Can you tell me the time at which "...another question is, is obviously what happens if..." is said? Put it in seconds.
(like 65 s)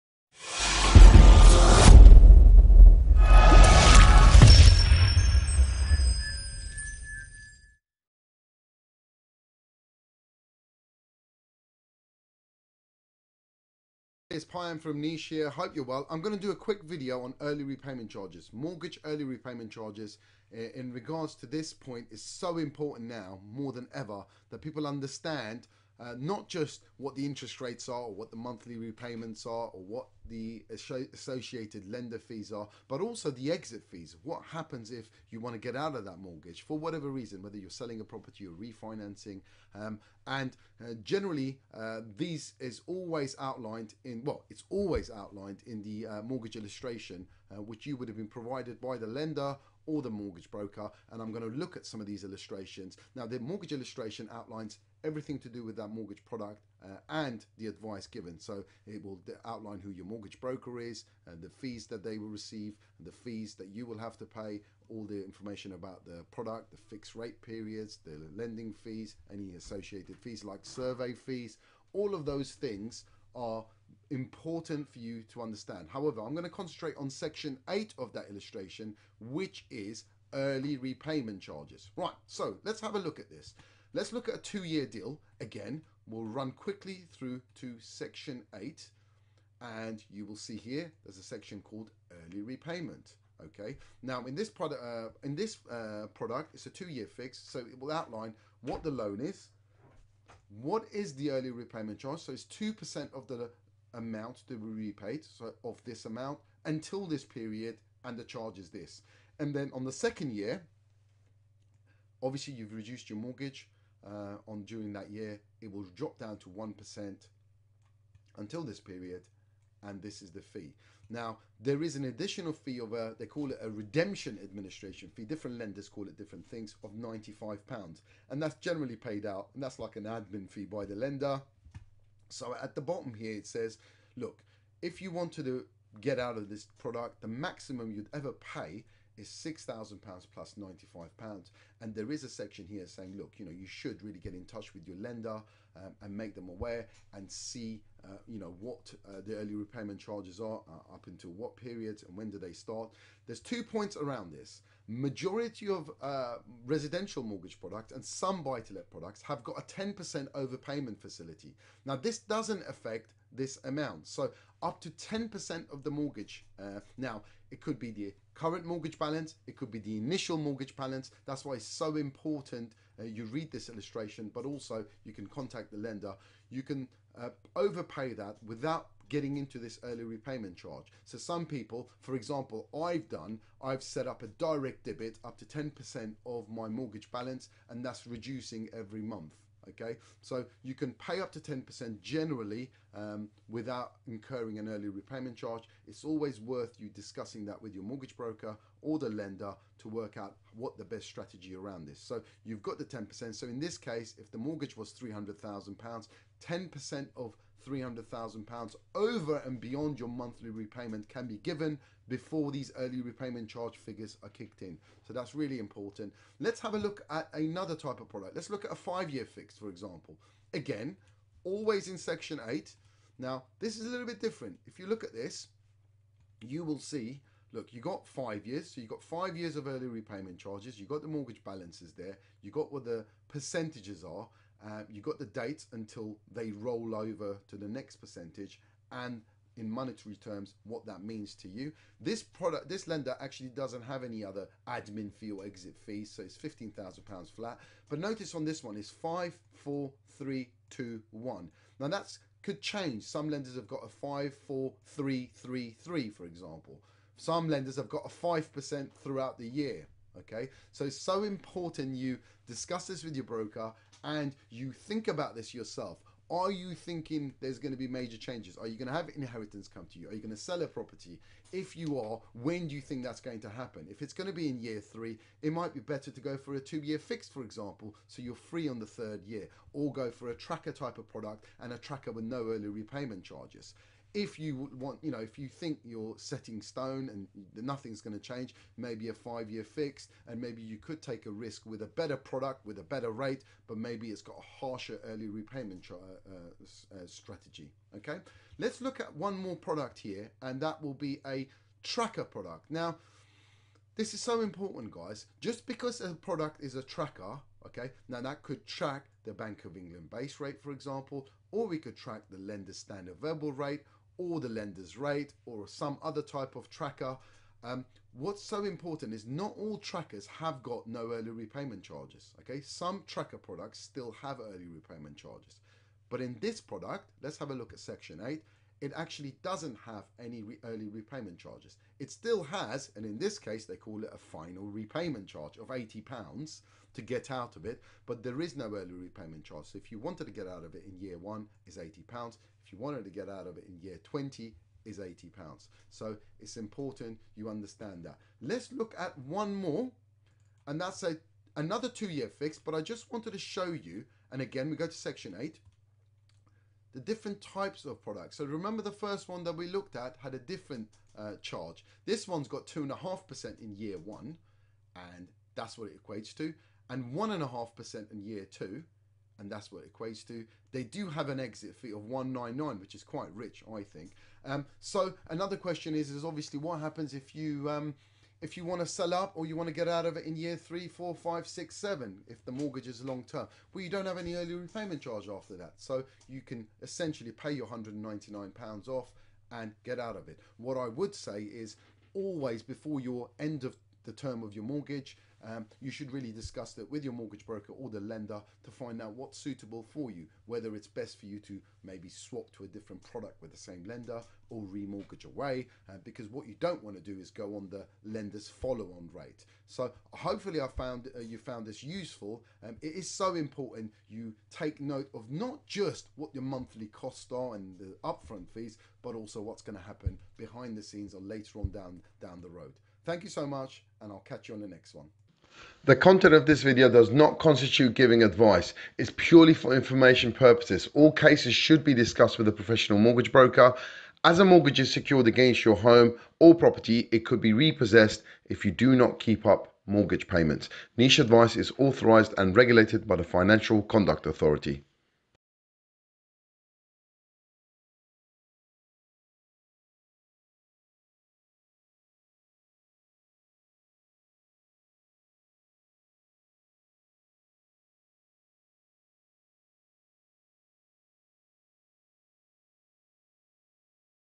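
375 s.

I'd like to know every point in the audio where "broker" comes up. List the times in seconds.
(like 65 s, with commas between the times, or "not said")
50 s, 60 s, 198 s, 263 s, 397 s, 433 s.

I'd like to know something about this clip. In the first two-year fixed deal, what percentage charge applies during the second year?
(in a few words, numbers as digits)
1%.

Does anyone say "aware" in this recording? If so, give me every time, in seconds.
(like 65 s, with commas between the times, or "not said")
146 s.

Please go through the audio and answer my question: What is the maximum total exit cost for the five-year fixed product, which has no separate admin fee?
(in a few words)
£15,000.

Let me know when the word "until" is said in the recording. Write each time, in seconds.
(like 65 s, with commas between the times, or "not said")
106 s, 118 s, 151 s, 235 s.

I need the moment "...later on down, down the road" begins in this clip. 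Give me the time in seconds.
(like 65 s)
421 s.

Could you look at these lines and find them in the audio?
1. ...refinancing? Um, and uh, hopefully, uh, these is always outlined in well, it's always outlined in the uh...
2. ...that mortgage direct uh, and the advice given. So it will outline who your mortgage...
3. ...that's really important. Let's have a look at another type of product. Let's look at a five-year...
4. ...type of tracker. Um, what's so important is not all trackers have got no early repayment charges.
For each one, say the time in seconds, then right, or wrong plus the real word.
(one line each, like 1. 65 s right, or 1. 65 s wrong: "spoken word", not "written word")
1. 38 s wrong: "generally", not "hopefully"
2. 55 s wrong: "product", not "direct"
3. 215 s right
4. 316 s right.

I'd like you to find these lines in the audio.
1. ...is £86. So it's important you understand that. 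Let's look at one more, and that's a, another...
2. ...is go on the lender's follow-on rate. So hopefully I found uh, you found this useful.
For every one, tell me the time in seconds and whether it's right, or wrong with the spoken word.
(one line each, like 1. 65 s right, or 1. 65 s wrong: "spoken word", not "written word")
1. 344 s wrong: "80", not "86"
2. 407 s right.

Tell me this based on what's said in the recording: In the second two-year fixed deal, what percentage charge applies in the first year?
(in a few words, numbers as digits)
2.5%.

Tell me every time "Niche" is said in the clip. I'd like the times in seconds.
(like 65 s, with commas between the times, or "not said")
15 s, 440 s.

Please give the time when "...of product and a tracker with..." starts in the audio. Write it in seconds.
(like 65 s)
280 s.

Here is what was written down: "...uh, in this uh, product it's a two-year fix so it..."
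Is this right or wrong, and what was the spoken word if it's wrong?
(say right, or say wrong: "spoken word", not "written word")
right.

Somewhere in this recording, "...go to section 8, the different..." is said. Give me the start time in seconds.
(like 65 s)
354 s.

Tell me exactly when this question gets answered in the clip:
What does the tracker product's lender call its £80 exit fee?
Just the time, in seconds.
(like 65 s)
334 s.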